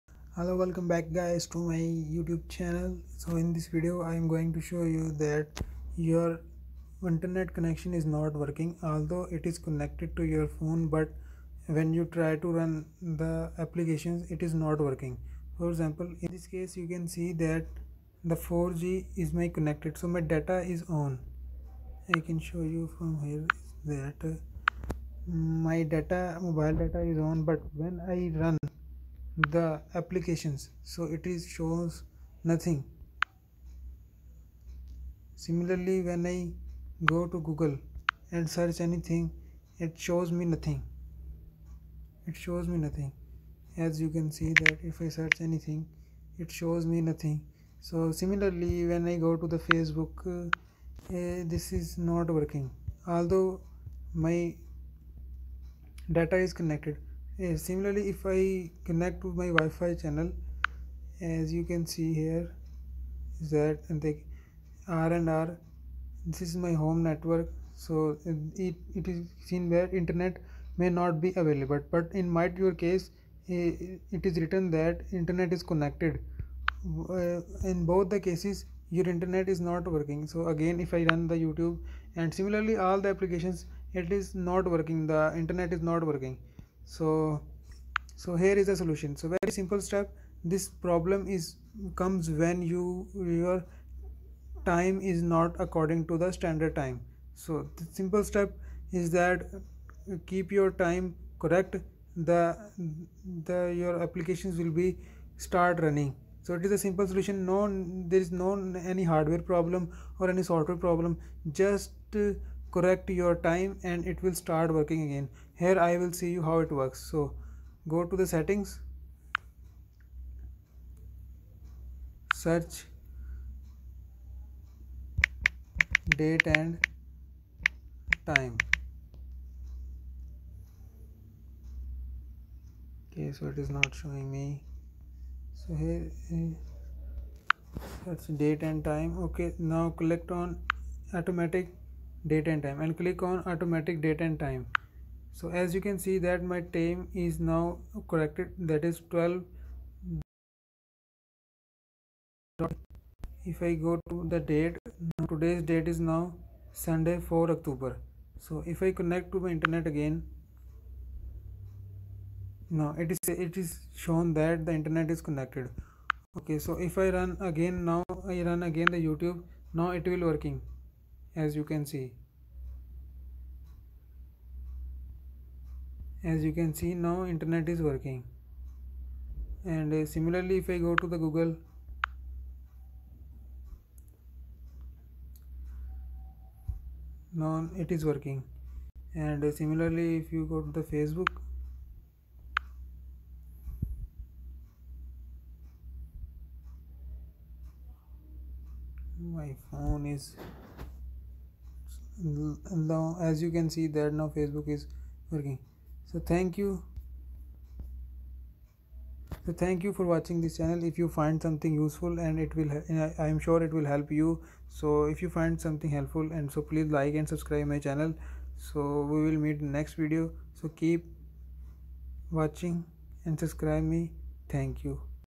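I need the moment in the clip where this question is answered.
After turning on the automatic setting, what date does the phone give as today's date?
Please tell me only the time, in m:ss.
2:36.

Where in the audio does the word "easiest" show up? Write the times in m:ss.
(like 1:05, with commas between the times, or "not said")
not said.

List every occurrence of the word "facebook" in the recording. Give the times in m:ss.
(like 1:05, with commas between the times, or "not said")
0:49, 3:10, 3:24.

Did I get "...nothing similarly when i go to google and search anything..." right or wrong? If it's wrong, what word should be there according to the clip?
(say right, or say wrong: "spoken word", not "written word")
right.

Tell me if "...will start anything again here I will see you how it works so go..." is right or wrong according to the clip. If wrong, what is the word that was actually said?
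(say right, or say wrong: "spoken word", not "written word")
wrong: "working", not "anything".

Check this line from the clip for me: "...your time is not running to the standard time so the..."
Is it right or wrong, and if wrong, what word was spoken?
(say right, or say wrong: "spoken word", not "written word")
wrong: "according", not "running".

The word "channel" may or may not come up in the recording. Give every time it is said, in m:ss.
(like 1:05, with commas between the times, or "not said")
0:02, 0:59, 3:30, 3:37.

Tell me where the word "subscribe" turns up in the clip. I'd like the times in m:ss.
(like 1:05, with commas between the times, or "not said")
3:37, 3:43.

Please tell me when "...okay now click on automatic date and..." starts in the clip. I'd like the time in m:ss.
2:19.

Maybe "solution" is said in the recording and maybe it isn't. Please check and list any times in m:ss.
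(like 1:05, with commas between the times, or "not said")
1:28, 1:47.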